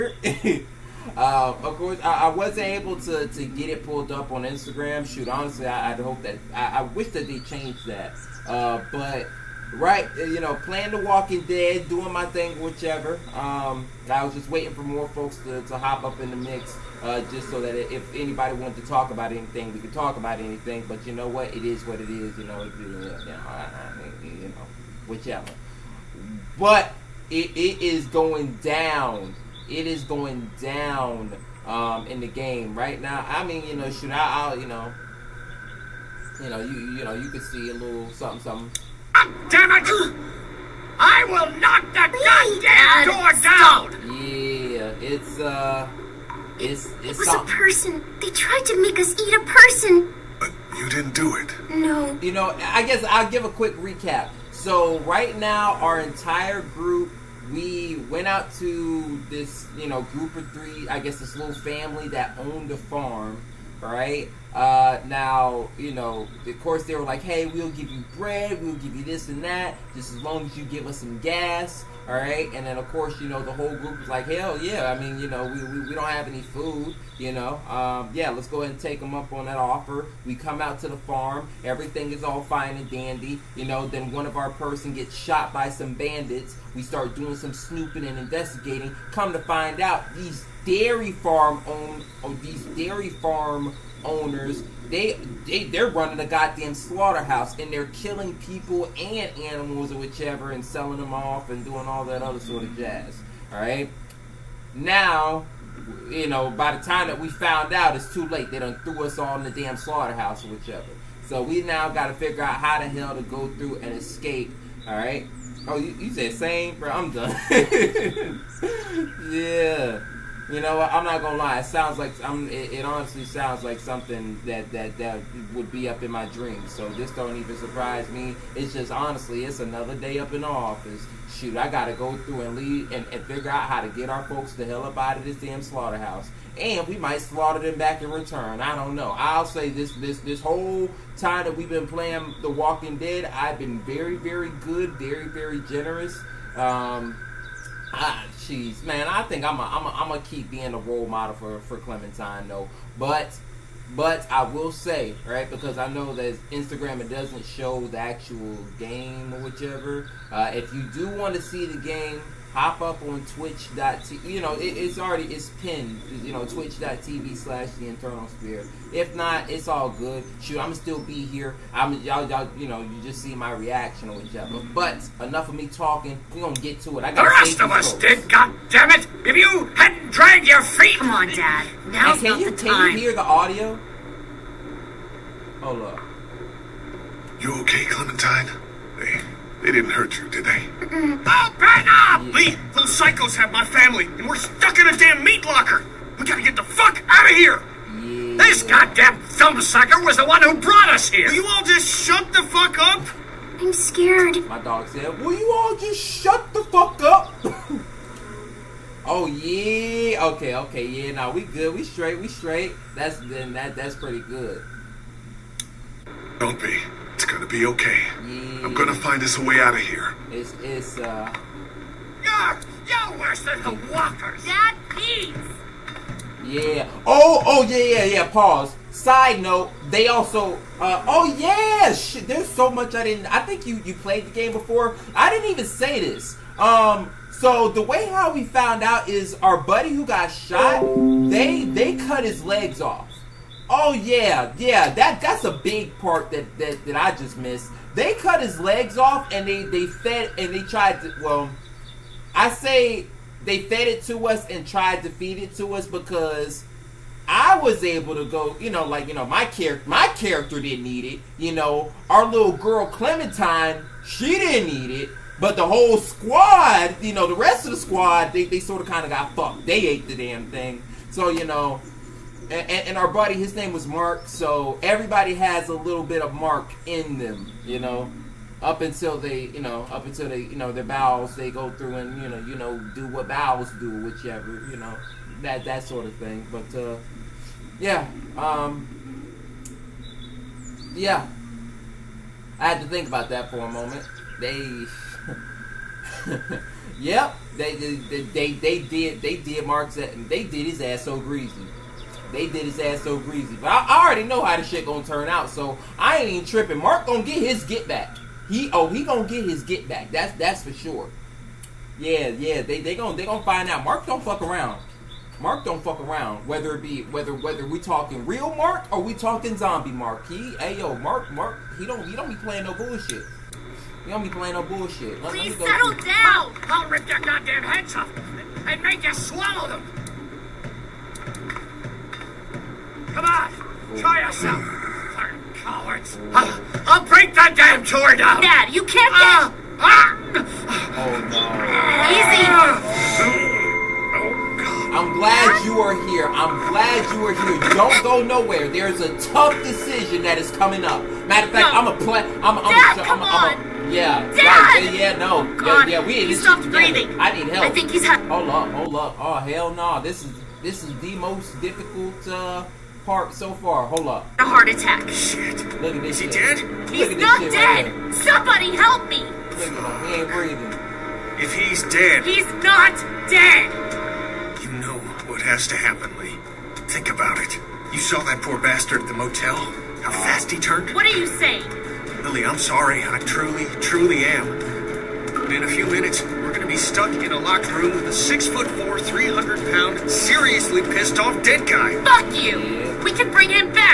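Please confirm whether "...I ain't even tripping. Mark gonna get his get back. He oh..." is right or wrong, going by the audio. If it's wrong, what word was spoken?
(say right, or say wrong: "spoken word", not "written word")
right.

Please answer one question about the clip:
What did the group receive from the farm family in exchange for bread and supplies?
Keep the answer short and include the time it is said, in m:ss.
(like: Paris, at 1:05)
gas, at 1:11.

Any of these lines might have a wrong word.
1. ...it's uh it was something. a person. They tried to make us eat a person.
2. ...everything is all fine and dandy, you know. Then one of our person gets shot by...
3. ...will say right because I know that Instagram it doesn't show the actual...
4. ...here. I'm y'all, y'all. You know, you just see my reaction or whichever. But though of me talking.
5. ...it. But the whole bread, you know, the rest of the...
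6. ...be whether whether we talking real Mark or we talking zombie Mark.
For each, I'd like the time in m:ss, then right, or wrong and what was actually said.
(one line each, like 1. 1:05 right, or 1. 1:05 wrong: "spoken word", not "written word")
1. 0:45 right
2. 1:21 right
3. 2:34 right
4. 2:51 wrong: "enough", not "though"
5. 4:25 wrong: "squad", not "bread"
6. 5:16 right.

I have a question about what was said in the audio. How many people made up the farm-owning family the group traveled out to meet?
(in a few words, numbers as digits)
three.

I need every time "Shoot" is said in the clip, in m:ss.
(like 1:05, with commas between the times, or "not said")
0:05, 2:11, 2:50.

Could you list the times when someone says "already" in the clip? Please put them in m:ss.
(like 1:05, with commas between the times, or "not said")
2:44, 5:04.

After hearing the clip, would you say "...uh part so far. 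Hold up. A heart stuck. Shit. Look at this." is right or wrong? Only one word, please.
wrong.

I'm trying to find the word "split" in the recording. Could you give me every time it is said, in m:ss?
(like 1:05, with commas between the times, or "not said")
not said.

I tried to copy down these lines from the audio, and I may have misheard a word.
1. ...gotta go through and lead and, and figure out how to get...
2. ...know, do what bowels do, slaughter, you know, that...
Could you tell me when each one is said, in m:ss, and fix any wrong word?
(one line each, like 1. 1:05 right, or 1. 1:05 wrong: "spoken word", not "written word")
1. 2:11 right
2. 4:42 wrong: "whichever", not "slaughter".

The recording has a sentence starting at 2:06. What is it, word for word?
So this don't even surprise me.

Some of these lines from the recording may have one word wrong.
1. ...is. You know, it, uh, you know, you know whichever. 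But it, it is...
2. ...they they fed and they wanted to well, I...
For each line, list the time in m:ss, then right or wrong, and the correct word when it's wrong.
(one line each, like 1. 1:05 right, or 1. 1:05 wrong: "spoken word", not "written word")
1. 0:22 right
2. 4:09 wrong: "tried", not "wanted".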